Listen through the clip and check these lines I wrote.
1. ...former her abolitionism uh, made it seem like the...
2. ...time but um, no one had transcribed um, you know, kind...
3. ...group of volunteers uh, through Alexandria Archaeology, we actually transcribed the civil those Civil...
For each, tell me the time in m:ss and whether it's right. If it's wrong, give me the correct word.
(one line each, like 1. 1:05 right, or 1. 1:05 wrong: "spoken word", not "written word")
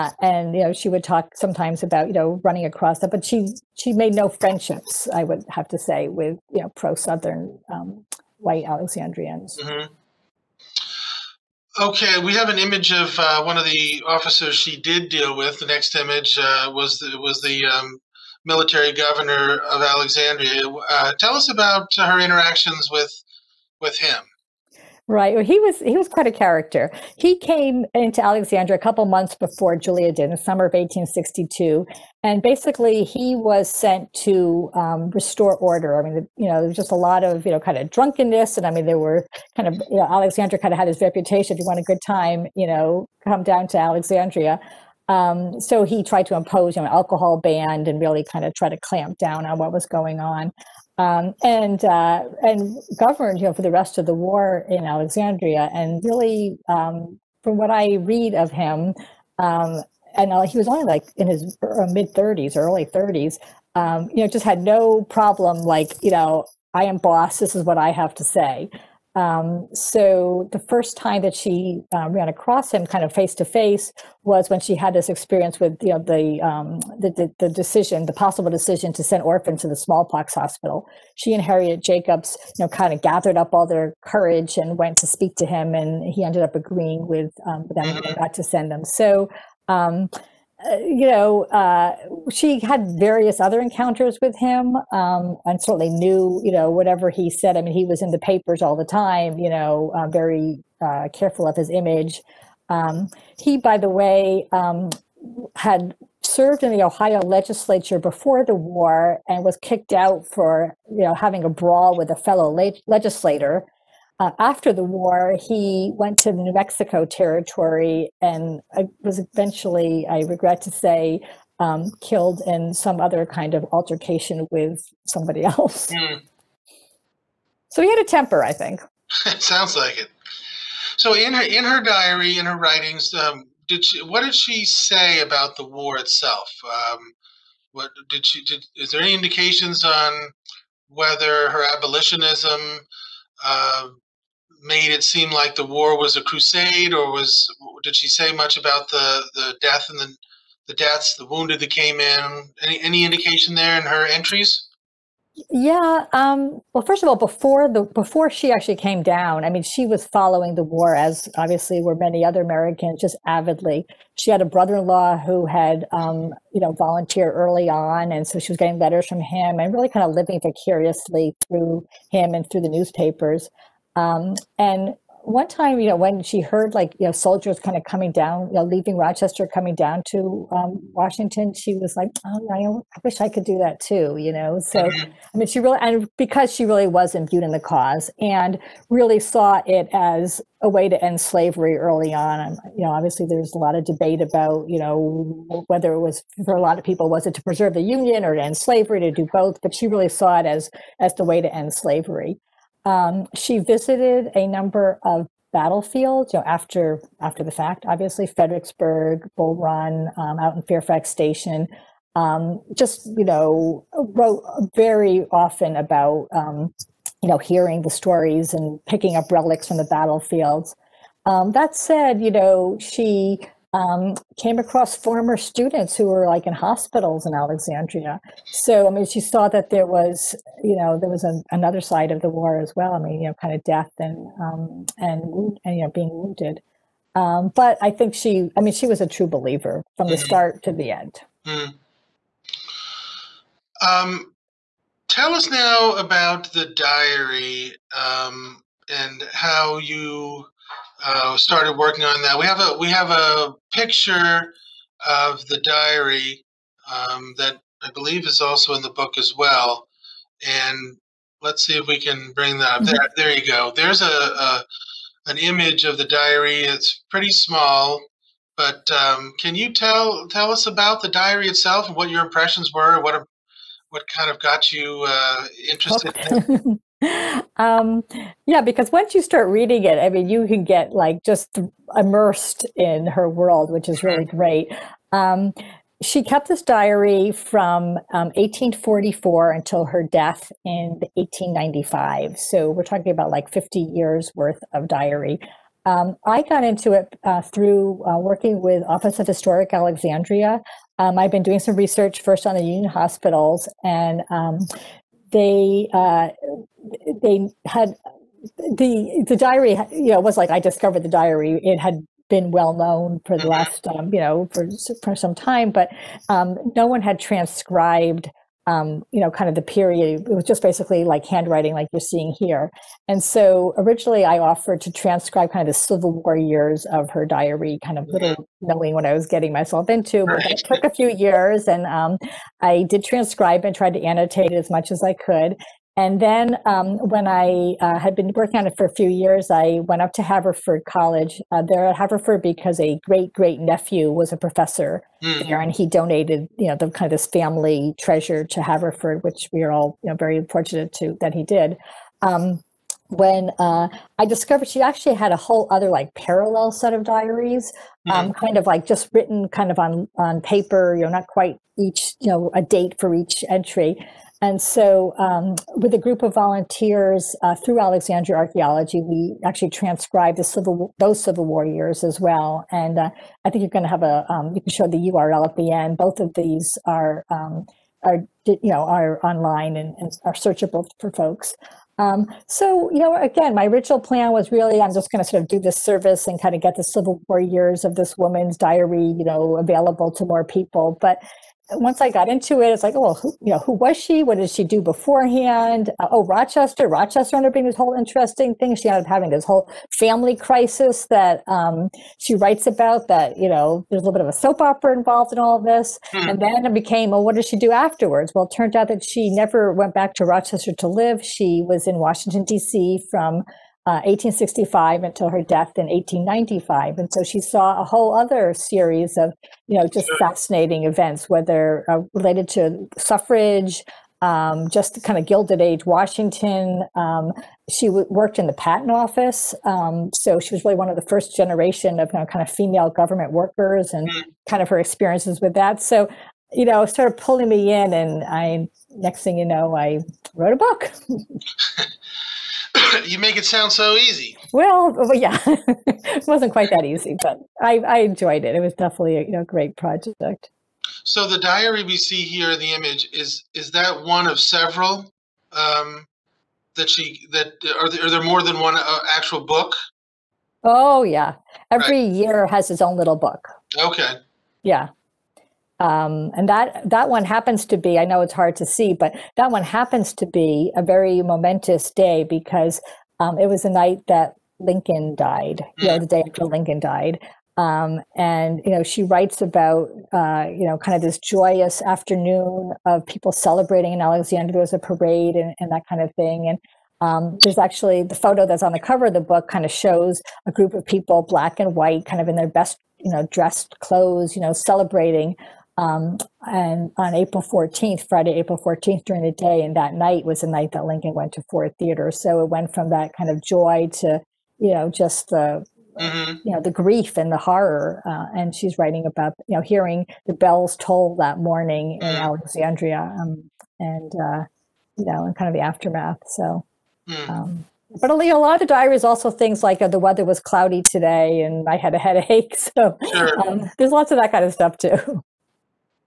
1. 2:20 wrong: "whether", not "former"
2. 5:15 right
3. 6:05 right.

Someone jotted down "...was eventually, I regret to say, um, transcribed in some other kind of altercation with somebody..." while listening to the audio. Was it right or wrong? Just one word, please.
wrong.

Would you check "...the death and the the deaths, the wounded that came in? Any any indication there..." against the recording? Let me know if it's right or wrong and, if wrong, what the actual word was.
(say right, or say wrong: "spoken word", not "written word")
right.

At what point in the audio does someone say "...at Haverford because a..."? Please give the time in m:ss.
5:41.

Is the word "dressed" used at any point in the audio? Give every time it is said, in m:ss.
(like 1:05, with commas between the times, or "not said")
8:13.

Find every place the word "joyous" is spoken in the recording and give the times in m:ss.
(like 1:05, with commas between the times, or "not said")
8:01.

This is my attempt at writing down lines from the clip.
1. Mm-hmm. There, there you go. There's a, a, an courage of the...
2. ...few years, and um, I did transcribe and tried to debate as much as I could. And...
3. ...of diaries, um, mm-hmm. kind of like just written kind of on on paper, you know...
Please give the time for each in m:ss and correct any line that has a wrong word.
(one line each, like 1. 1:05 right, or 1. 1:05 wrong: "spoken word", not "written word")
1. 4:22 wrong: "image", not "courage"
2. 5:30 wrong: "annotate", not "debate"
3. 5:56 right.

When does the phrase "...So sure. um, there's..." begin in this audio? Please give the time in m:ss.
8:42.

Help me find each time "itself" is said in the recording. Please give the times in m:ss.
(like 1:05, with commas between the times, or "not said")
2:15, 4:31.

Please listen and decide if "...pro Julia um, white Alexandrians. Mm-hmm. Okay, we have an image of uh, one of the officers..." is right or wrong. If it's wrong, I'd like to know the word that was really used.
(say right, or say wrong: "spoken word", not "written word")
wrong: "Southern", not "Julia".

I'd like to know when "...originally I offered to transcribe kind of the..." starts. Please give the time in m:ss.
5:23.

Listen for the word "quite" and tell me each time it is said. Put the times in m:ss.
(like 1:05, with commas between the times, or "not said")
0:26, 6:01, 7:26.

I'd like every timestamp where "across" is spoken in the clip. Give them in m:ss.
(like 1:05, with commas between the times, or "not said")
0:02, 1:12, 3:44.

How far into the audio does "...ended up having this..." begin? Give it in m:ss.
6:38.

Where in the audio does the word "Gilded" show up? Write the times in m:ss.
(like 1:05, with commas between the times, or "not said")
7:05.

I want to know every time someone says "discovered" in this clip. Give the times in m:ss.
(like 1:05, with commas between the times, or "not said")
5:10, 5:54.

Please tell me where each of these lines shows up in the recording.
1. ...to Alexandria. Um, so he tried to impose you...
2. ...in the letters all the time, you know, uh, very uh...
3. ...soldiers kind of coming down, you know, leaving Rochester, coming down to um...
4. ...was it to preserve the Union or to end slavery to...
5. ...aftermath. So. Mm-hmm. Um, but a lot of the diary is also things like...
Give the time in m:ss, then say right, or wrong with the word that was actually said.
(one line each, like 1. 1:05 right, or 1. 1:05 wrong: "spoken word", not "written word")
1. 0:43 right
2. 1:38 wrong: "papers", not "letters"
3. 2:57 right
4. 3:17 right
5. 8:35 right.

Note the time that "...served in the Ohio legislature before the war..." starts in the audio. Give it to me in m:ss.
1:46.